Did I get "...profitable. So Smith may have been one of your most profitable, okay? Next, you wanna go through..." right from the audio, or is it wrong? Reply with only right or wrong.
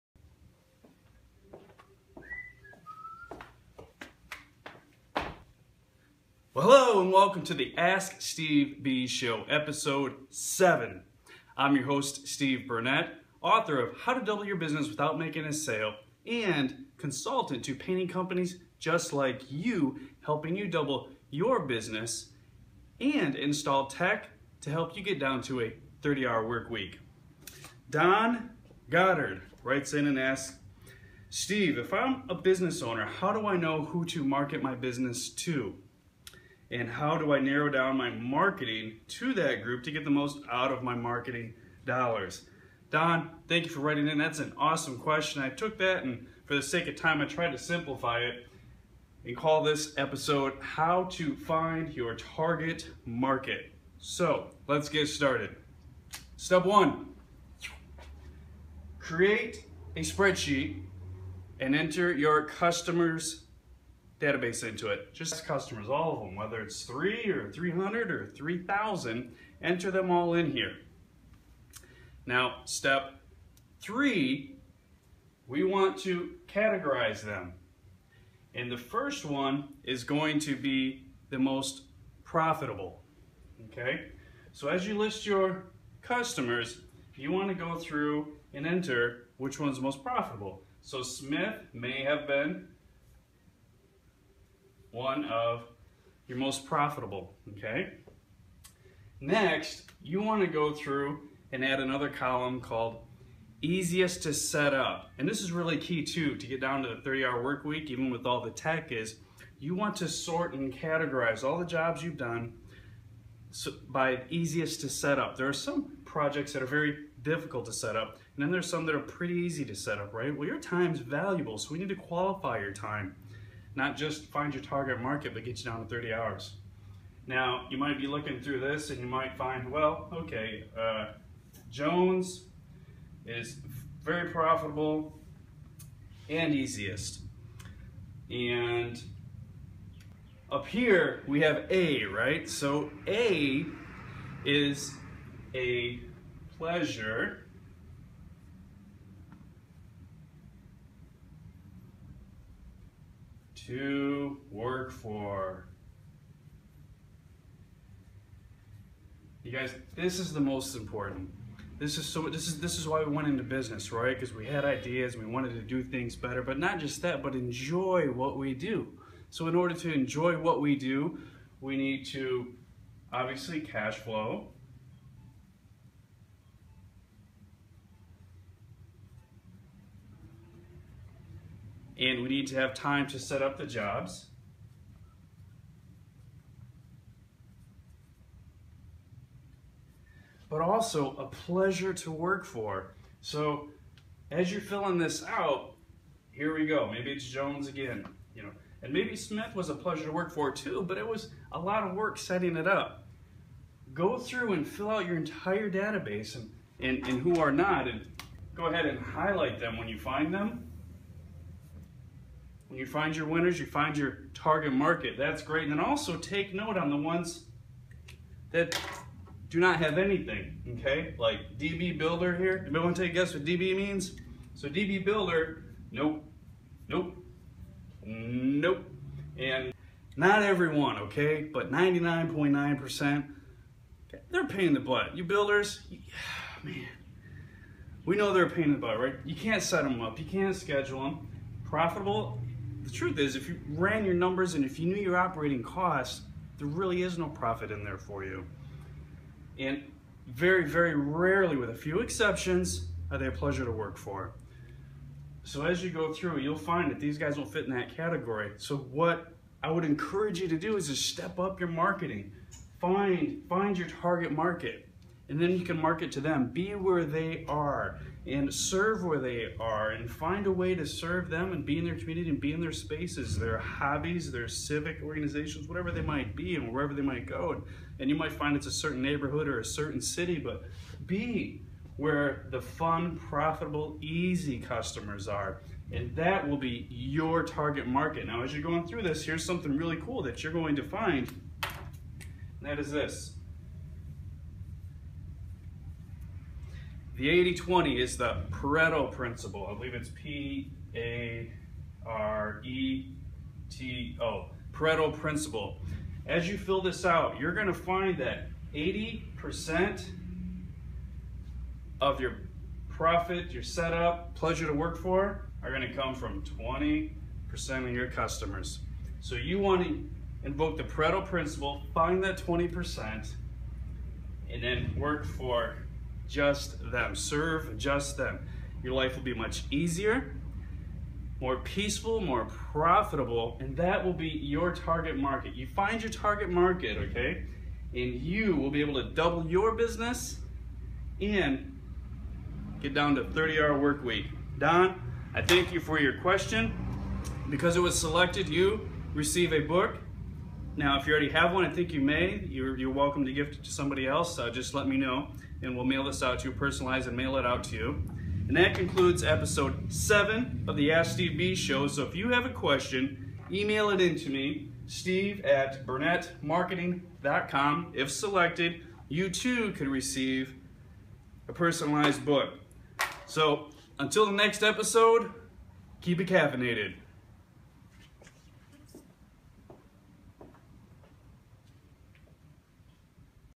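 right.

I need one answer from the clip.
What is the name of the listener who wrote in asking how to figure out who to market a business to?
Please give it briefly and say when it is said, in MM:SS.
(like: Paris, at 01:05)
Don Goddard, at 00:27.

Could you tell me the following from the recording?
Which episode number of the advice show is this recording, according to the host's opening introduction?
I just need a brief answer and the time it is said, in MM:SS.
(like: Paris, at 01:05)
7, at 00:09.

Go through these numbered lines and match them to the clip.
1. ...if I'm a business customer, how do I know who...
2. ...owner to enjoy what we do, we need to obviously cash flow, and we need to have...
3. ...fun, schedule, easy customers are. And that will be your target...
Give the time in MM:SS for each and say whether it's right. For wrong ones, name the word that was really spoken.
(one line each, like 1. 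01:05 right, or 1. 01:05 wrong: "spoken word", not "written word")
1. 00:31 wrong: "owner", not "customer"
2. 02:49 wrong: "order", not "owner"
3. 04:42 wrong: "profitable", not "schedule".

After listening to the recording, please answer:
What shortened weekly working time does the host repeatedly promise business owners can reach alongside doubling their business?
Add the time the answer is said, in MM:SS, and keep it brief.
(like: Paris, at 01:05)
30 hours, at 02:05.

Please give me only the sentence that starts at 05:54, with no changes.
Uh, just let me know, and we'll mail this out to you, personalize and mail it out to you.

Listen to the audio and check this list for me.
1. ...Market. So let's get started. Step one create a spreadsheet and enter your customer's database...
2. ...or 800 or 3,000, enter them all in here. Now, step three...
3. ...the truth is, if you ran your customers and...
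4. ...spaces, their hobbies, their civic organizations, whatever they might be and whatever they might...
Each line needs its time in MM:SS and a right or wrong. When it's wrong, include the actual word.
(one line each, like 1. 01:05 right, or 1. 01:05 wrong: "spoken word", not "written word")
1. 00:53 right
2. 01:07 wrong: "300", not "800"
3. 04:02 wrong: "numbers", not "customers"
4. 04:32 wrong: "wherever", not "whatever".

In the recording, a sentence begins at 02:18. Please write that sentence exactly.
And up here, we have A, right?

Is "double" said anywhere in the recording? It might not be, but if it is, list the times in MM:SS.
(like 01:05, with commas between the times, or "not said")
00:14, 00:20, 05:39.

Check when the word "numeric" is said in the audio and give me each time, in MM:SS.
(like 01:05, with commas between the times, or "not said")
not said.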